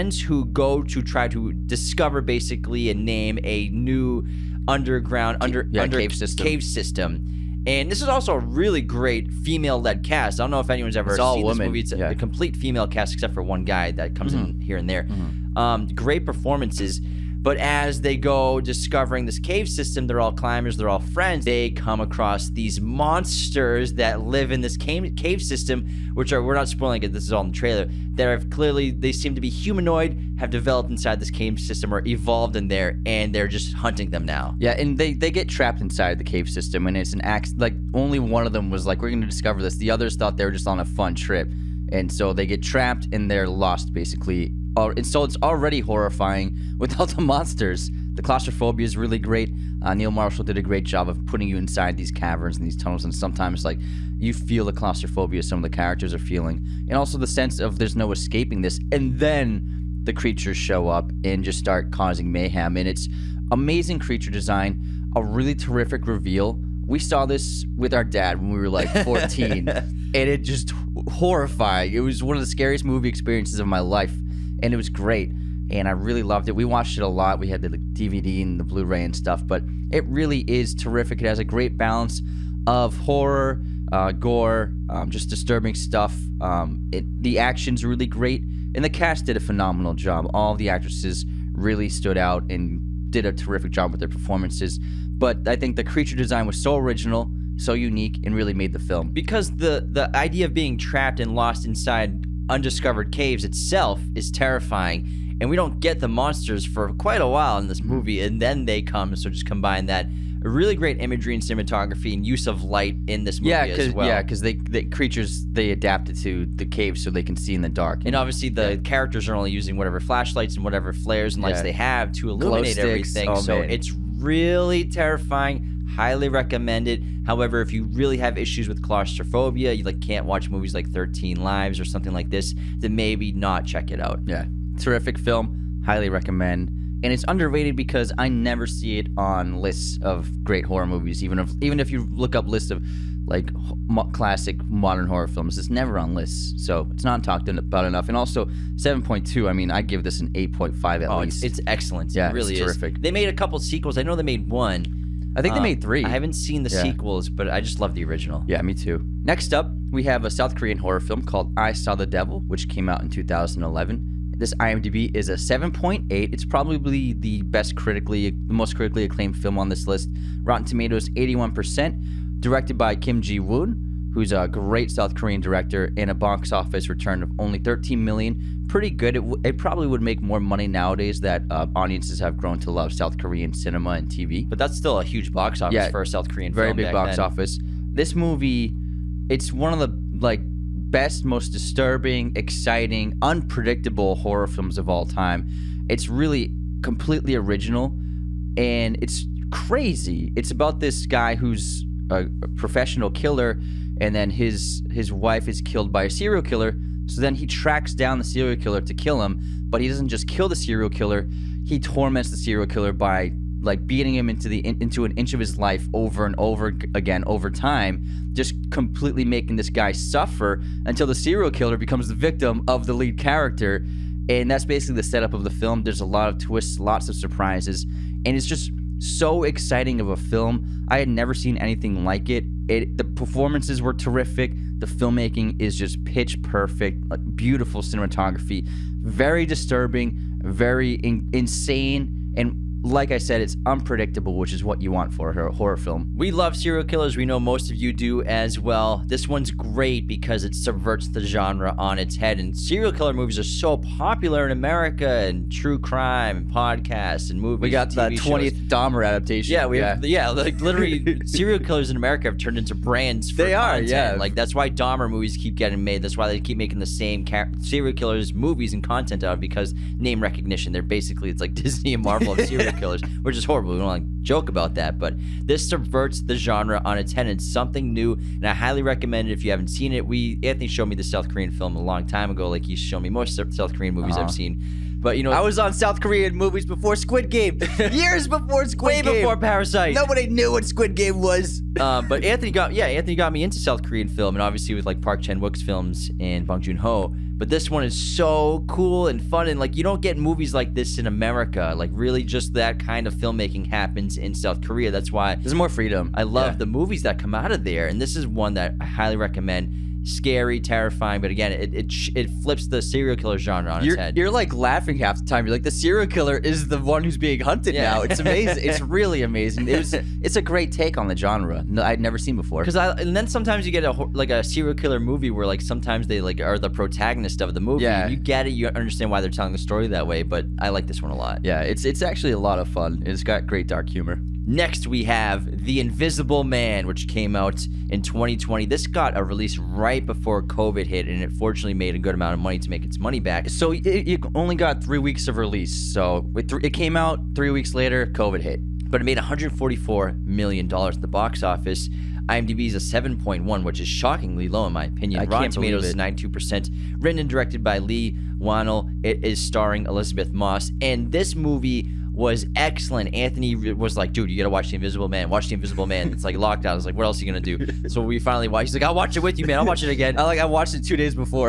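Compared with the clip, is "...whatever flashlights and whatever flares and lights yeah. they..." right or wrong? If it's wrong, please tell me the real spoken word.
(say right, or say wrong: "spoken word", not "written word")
right.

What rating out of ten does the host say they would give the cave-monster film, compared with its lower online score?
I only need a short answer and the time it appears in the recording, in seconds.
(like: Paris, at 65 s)
8.5, at 150 s.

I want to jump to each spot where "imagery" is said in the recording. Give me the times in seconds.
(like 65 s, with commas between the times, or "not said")
111 s.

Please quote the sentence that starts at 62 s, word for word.
And it's amazing creature design, a really terrific reveal.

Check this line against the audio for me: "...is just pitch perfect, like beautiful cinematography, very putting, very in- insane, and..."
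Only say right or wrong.
wrong.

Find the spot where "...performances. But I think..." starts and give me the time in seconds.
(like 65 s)
94 s.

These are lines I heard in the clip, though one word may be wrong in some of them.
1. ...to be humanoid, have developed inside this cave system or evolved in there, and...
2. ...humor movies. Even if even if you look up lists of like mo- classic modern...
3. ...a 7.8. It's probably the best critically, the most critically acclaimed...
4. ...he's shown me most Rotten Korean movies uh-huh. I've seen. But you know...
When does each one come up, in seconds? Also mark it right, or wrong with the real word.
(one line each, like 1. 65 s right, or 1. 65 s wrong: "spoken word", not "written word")
1. 29 s right
2. 140 s wrong: "horror", not "humor"
3. 165 s right
4. 282 s wrong: "South", not "Rotten".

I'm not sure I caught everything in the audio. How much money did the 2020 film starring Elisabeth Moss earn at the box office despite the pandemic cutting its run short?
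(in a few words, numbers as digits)
$144 million.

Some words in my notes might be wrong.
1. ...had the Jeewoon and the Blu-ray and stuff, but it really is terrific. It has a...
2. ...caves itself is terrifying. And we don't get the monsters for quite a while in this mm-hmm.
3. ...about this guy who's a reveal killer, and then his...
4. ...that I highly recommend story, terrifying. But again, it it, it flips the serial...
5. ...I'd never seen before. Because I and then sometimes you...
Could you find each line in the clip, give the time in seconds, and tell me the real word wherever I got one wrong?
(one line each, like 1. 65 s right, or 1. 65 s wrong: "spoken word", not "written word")
1. 77 s wrong: "DVD", not "Jeewoon"
2. 103 s right
3. 200 s wrong: "professional", not "reveal"
4. 308 s wrong: "scary", not "story"
5. 321 s right.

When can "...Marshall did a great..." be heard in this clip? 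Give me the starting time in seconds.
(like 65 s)
50 s.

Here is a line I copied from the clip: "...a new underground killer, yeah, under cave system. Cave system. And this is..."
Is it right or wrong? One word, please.
wrong.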